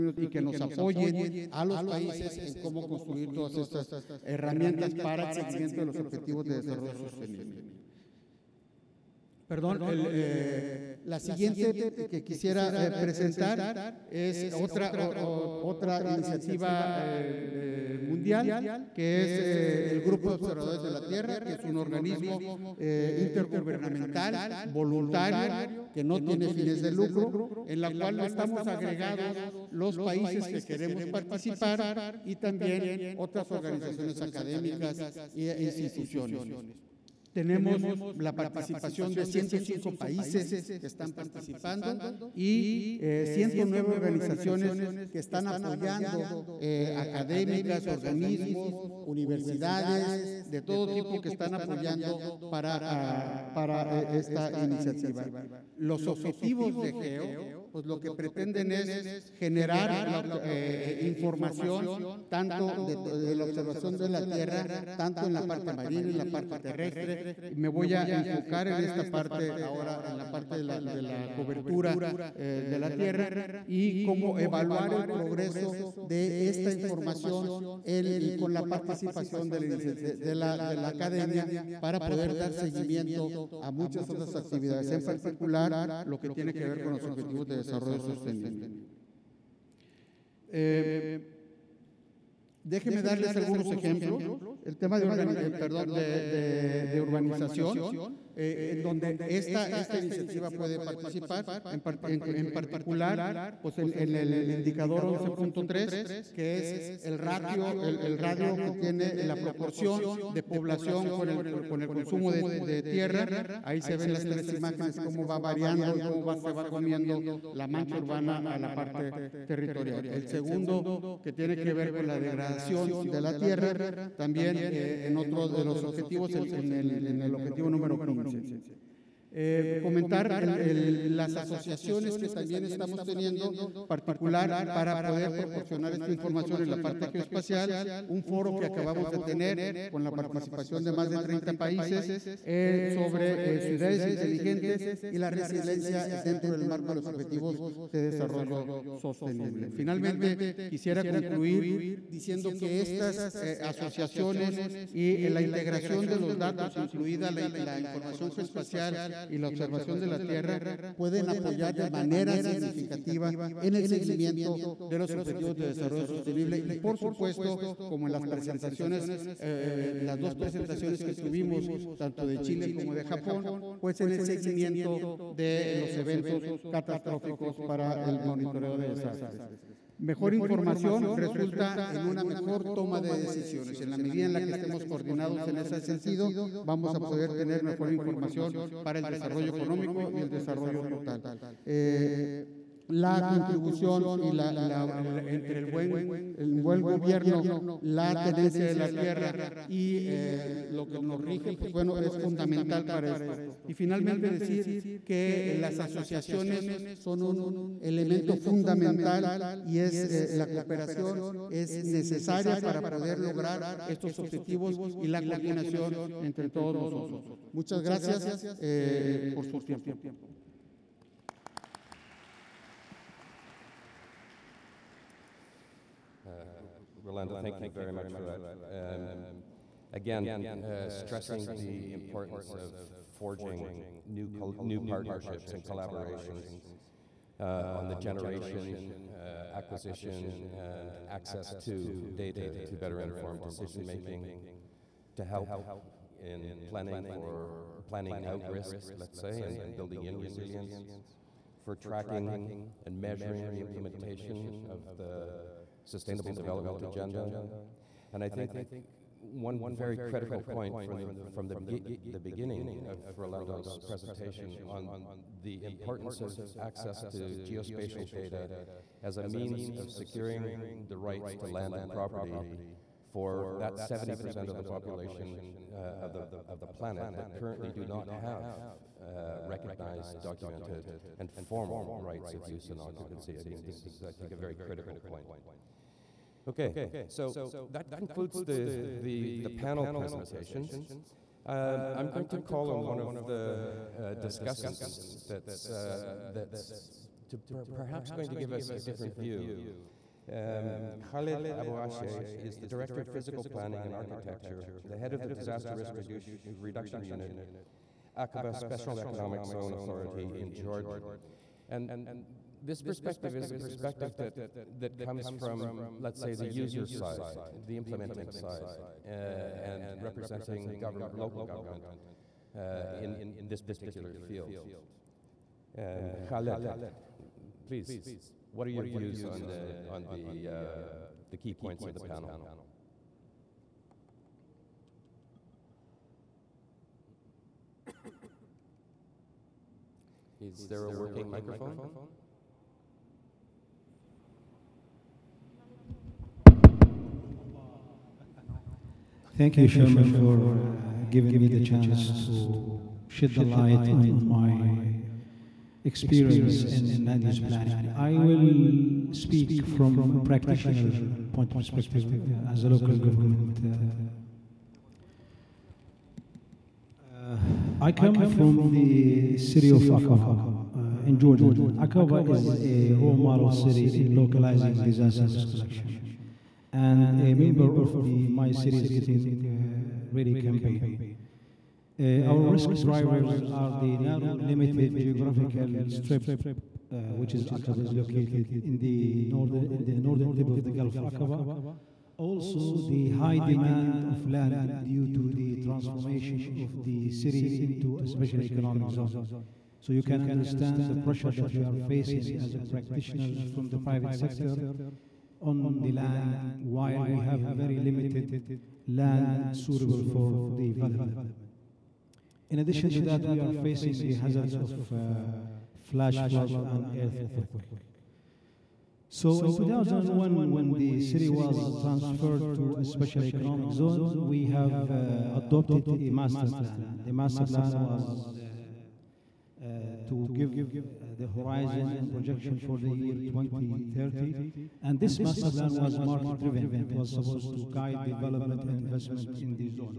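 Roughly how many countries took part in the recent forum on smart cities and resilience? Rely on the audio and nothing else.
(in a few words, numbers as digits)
More than 30.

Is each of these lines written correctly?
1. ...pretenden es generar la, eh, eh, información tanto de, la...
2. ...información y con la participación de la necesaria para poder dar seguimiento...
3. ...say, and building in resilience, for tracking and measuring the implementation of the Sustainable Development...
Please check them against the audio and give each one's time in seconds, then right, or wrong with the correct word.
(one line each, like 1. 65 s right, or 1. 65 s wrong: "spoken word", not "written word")
1. 58 s right
2. 76 s wrong: "academia", not "necesaria"
3. 249 s right.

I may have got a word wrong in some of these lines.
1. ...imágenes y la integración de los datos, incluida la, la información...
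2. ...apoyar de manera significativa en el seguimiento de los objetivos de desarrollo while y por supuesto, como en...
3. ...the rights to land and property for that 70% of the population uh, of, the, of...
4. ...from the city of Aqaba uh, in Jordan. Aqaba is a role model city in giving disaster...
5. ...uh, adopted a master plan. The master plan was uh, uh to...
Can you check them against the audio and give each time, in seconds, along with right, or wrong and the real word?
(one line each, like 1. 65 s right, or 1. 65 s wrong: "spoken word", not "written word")
1. 153 s wrong: "asociaciones", not "imágenes"
2. 161 s wrong: "sostenible", not "while"
3. 270 s right
4. 368 s wrong: "localizing", not "giving"
5. 424 s right.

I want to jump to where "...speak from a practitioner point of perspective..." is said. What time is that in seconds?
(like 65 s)
359 s.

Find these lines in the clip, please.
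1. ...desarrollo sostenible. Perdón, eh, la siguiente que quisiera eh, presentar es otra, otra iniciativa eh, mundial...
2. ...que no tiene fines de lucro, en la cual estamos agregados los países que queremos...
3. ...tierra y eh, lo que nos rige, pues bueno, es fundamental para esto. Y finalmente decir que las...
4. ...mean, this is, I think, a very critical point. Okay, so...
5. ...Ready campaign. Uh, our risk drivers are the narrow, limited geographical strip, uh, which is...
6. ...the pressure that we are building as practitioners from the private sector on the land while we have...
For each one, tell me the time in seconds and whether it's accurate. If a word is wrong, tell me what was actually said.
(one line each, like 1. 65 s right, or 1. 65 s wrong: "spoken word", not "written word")
1. 6 s right
2. 25 s right
3. 198 s right
4. 283 s right
5. 380 s right
6. 400 s wrong: "facing", not "building".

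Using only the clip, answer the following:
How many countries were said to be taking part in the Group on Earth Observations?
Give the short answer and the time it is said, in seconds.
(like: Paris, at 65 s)
105, at 39 s.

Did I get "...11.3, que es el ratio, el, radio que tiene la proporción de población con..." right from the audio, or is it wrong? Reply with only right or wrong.
right.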